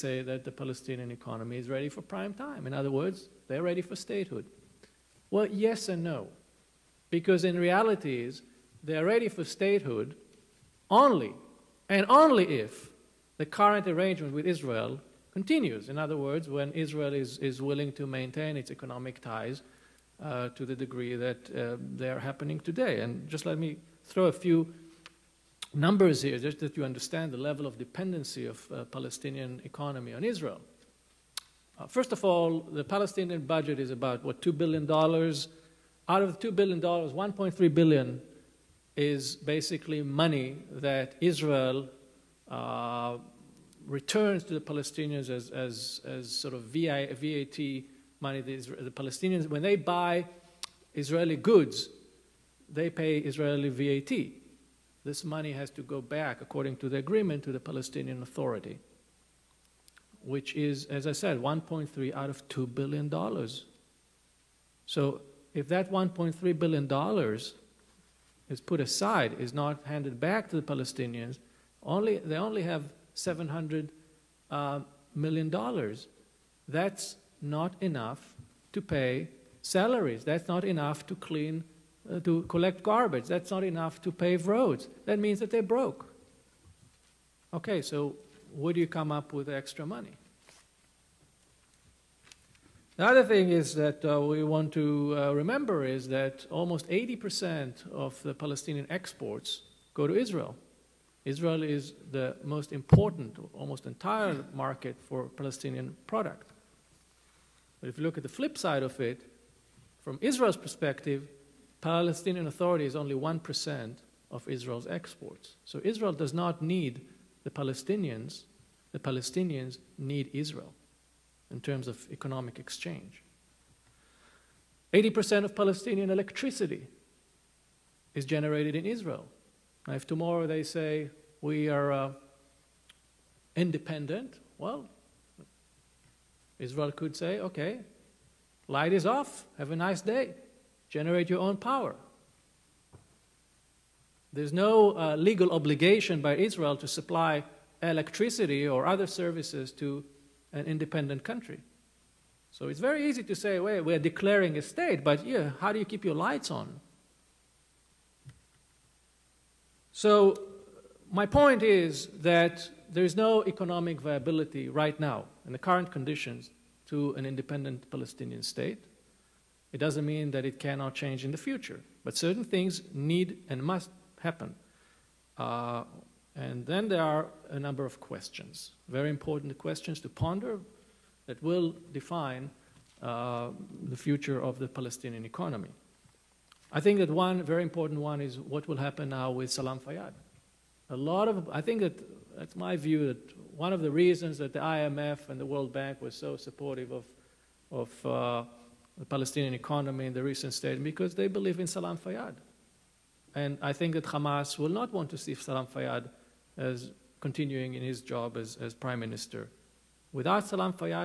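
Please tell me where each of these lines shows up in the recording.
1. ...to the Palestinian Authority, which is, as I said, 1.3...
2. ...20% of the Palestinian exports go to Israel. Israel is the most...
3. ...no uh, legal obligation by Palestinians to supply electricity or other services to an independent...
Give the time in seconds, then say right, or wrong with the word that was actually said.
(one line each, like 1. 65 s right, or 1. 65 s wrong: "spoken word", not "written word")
1. 57 s right
2. 96 s wrong: "80", not "20"
3. 144 s wrong: "Israel", not "Palestinians".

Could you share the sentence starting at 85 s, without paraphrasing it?
That means that they are broke.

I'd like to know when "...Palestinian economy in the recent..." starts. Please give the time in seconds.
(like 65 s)
199 s.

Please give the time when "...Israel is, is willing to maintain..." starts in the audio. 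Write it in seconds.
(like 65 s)
16 s.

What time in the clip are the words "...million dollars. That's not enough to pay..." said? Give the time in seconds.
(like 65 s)
75 s.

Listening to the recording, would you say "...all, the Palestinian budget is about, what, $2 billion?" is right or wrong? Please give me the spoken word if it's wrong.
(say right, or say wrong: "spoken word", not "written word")
right.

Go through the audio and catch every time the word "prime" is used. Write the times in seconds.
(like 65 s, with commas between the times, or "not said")
2 s, 208 s.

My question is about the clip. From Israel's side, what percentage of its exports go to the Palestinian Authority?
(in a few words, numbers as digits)
1%.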